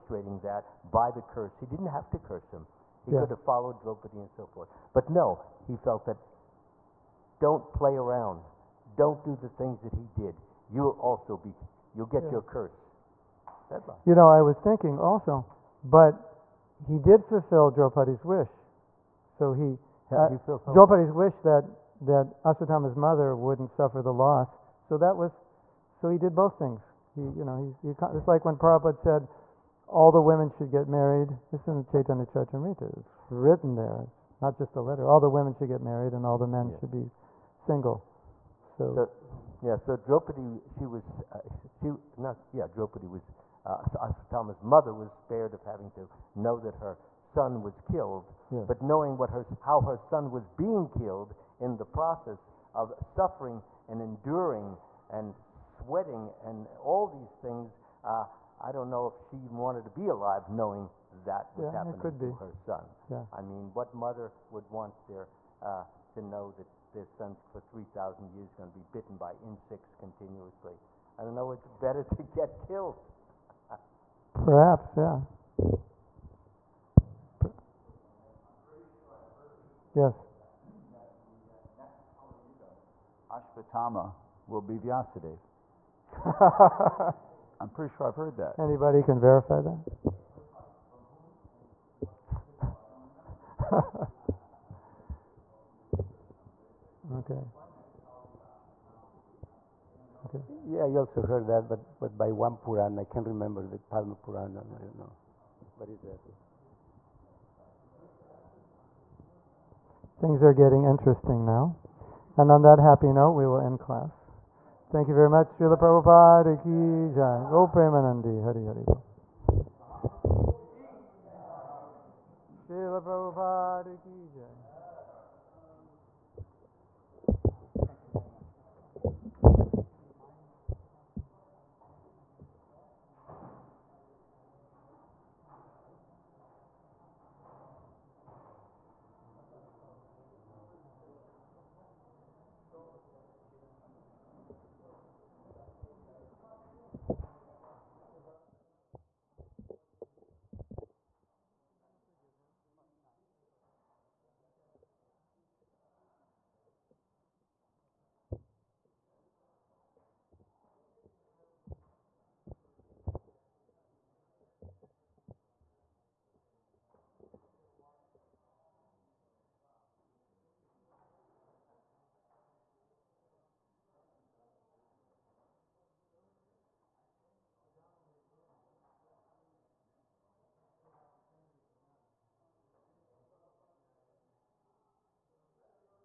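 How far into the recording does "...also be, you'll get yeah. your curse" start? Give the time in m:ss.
0:10.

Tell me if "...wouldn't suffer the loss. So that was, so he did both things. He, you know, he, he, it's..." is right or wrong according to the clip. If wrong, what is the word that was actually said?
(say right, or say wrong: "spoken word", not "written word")
right.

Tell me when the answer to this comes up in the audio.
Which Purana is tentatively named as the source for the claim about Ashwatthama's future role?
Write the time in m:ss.
1:43.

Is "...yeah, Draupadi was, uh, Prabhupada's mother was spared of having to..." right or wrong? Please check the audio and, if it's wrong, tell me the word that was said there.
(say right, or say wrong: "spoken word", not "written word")
wrong: "Ashwatthama", not "Prabhupada".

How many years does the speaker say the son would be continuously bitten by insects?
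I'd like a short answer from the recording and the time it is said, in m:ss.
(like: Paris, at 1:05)
3,000, at 1:07.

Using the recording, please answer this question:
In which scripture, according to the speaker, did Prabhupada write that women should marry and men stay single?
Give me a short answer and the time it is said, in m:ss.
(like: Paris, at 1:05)
Chaitanya Charitamrita, at 0:31.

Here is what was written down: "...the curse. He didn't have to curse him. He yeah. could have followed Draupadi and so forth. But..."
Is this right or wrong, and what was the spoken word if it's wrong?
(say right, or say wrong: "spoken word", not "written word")
right.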